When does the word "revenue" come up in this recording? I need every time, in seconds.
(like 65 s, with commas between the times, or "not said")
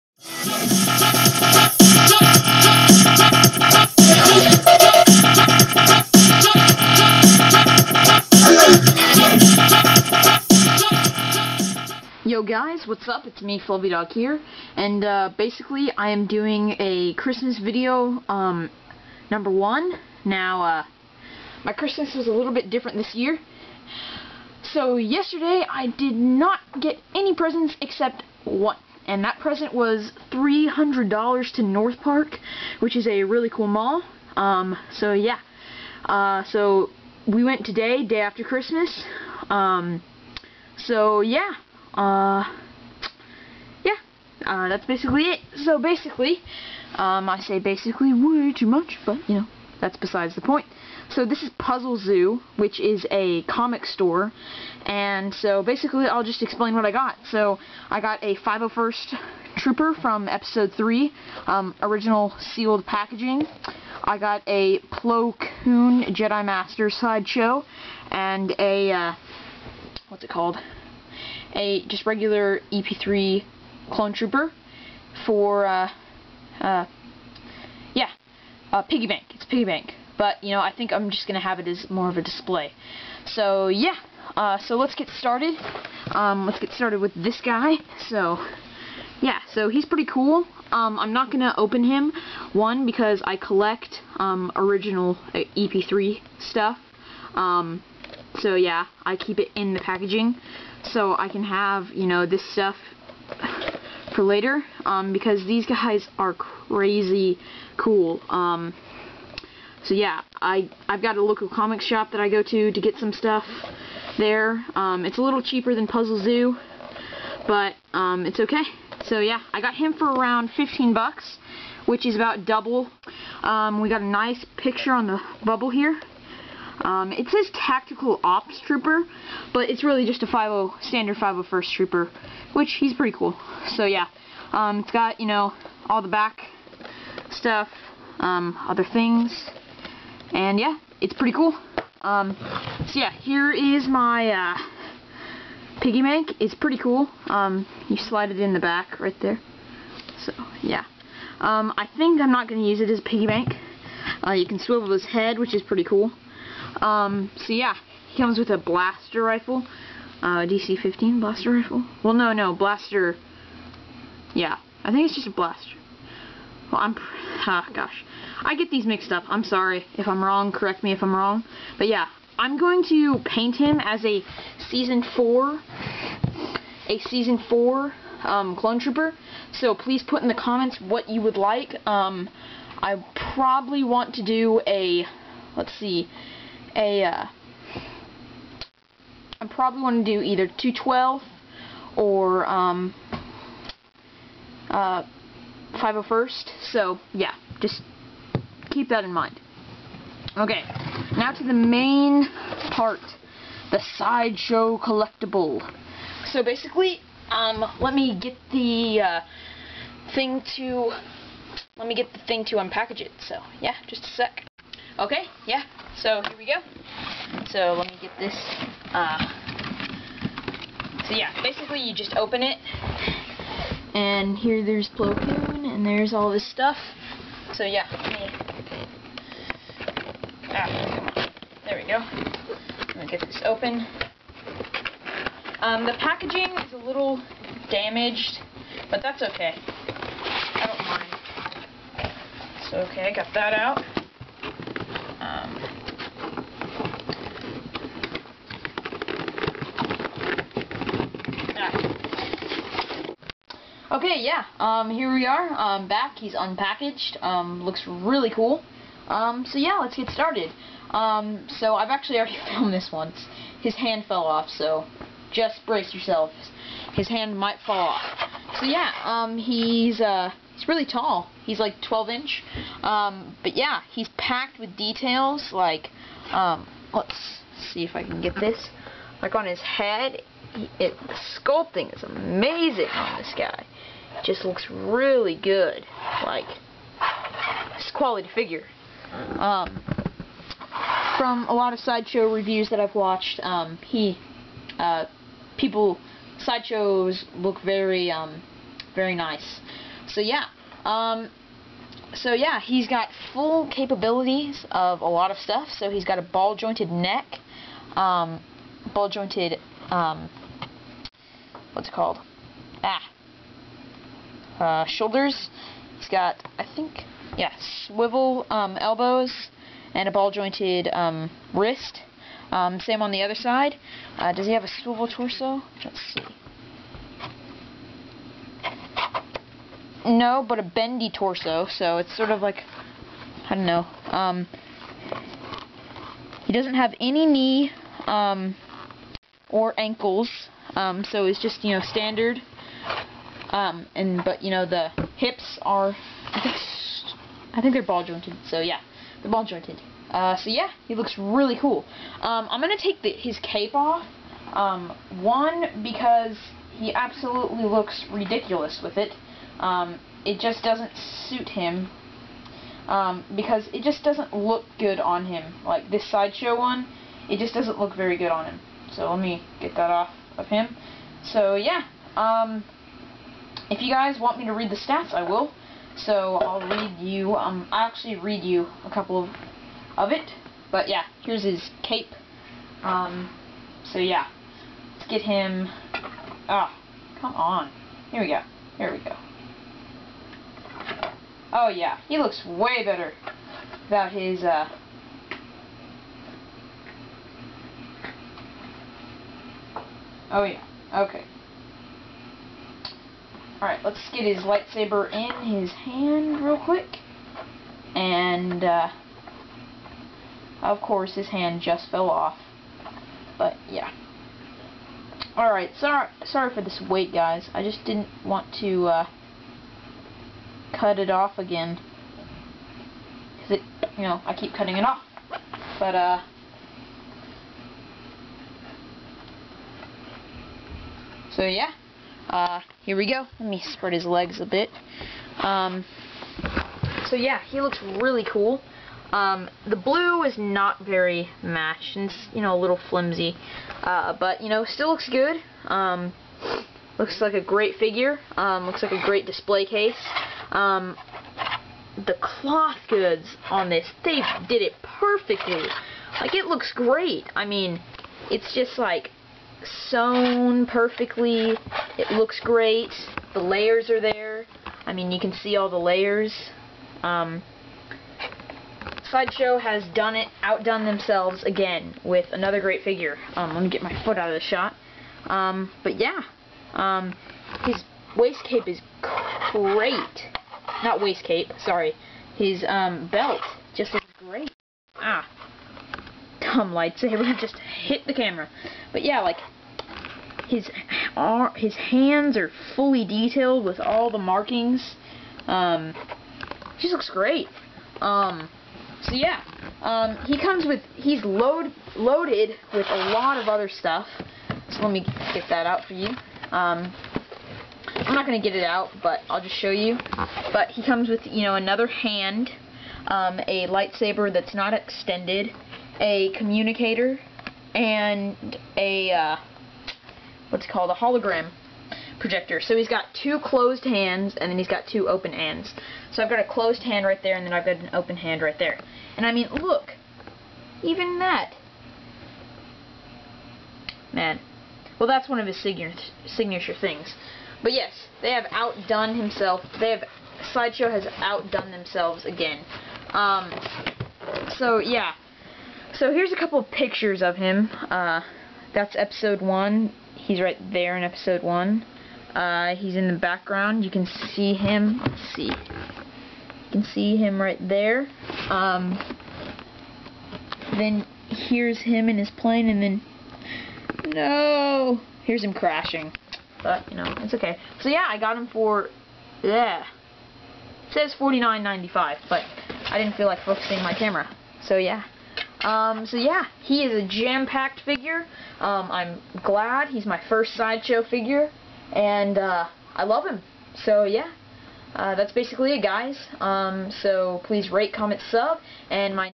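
not said.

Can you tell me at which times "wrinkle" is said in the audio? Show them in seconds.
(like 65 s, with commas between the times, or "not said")
not said.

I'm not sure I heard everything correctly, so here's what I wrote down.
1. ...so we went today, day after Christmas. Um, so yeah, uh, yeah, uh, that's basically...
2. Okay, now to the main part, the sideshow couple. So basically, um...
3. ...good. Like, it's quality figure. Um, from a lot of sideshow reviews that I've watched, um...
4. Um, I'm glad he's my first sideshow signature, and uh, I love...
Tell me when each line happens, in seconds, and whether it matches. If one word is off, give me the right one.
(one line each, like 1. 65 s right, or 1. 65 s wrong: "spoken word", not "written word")
1. 36 s right
2. 200 s wrong: "collectible", not "couple"
3. 285 s right
4. 578 s wrong: "figure", not "signature".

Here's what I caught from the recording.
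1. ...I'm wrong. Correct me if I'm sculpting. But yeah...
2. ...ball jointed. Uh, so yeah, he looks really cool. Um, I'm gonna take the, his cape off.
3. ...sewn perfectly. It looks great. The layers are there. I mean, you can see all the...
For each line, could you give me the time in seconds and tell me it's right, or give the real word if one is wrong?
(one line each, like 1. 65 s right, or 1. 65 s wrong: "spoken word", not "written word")
1. 170 s wrong: "wrong", not "sculpting"
2. 349 s right
3. 459 s right.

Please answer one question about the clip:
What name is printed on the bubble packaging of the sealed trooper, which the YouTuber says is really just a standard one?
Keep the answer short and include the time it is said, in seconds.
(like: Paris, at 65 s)
Tactical Ops Trooper, at 127 s.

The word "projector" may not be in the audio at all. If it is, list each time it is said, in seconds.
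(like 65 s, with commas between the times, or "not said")
522 s.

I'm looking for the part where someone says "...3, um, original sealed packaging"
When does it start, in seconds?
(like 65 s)
60 s.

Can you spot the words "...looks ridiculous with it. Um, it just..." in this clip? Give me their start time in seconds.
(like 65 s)
357 s.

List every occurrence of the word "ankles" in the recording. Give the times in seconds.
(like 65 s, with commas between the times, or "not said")
339 s.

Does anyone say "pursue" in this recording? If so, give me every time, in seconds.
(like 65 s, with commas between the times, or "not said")
not said.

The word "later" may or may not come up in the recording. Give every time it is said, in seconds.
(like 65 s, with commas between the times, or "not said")
104 s.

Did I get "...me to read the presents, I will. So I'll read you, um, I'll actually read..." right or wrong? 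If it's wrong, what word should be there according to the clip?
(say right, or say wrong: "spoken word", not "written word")
wrong: "stats", not "presents".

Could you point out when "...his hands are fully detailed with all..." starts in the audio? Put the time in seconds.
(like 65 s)
491 s.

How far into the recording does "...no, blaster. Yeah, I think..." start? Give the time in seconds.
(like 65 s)
162 s.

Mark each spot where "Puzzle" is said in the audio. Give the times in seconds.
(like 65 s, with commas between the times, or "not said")
51 s, 115 s.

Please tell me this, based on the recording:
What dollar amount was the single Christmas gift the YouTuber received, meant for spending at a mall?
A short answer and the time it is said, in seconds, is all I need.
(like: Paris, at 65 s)
$300, at 30 s.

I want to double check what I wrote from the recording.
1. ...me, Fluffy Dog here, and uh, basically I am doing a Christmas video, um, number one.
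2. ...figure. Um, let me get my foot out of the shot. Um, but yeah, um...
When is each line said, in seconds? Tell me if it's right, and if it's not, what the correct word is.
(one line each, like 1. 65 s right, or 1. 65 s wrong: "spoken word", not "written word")
1. 13 s right
2. 472 s right.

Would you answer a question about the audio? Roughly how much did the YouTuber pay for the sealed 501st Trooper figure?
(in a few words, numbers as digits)
15 bucks.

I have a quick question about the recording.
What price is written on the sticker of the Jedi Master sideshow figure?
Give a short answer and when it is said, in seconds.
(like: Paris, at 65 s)
$49.95, at 571 s.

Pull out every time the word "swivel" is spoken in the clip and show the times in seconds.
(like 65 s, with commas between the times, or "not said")
154 s, 317 s, 324 s.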